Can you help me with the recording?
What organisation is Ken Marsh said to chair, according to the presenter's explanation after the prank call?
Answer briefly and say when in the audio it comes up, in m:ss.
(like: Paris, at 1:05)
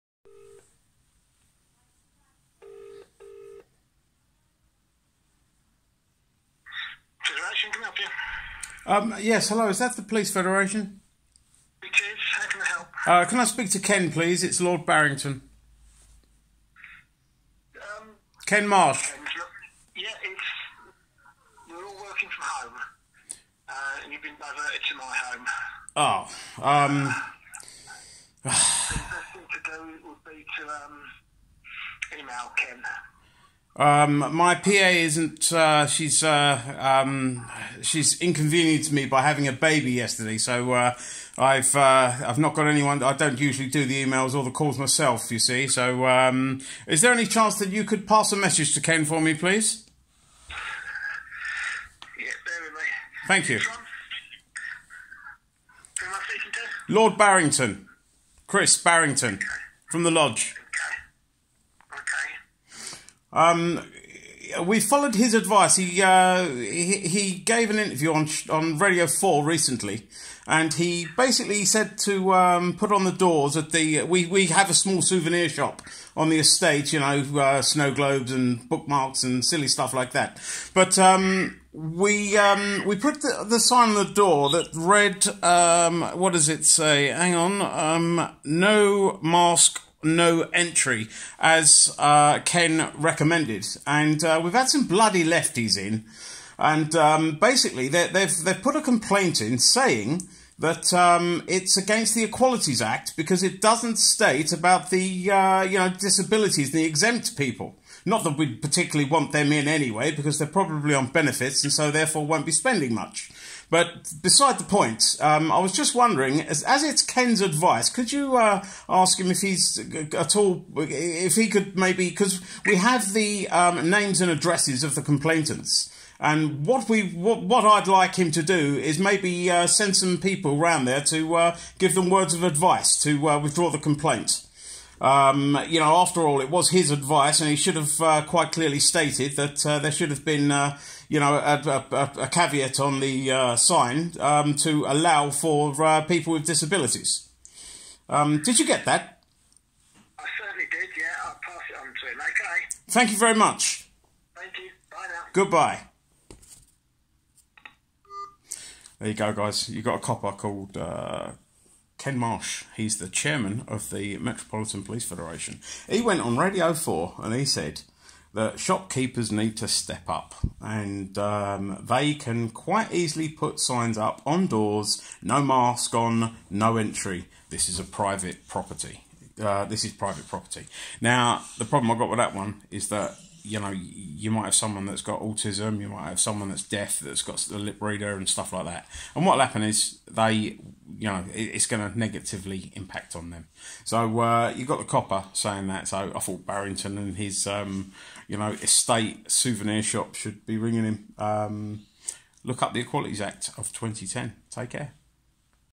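Metropolitan Police Federation, at 2:44.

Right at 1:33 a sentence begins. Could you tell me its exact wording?
And uh, we've had some bloody lefties in.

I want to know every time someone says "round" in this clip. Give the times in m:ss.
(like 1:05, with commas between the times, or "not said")
2:10.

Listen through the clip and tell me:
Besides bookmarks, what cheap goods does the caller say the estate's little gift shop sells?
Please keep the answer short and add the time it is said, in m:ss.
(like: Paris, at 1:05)
Snow globes, at 1:17.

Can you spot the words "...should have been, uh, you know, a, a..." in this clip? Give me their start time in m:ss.
2:19.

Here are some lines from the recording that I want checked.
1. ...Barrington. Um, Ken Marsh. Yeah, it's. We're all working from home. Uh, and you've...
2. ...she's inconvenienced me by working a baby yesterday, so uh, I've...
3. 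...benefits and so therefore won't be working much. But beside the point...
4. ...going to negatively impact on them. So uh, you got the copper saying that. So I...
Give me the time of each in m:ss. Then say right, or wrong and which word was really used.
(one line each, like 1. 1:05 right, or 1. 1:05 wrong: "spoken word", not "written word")
1. 0:14 right
2. 0:37 wrong: "having", not "working"
3. 1:51 wrong: "spending", not "working"
4. 3:11 right.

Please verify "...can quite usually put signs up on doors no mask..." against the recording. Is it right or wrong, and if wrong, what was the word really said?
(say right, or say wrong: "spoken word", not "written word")
wrong: "easily", not "usually".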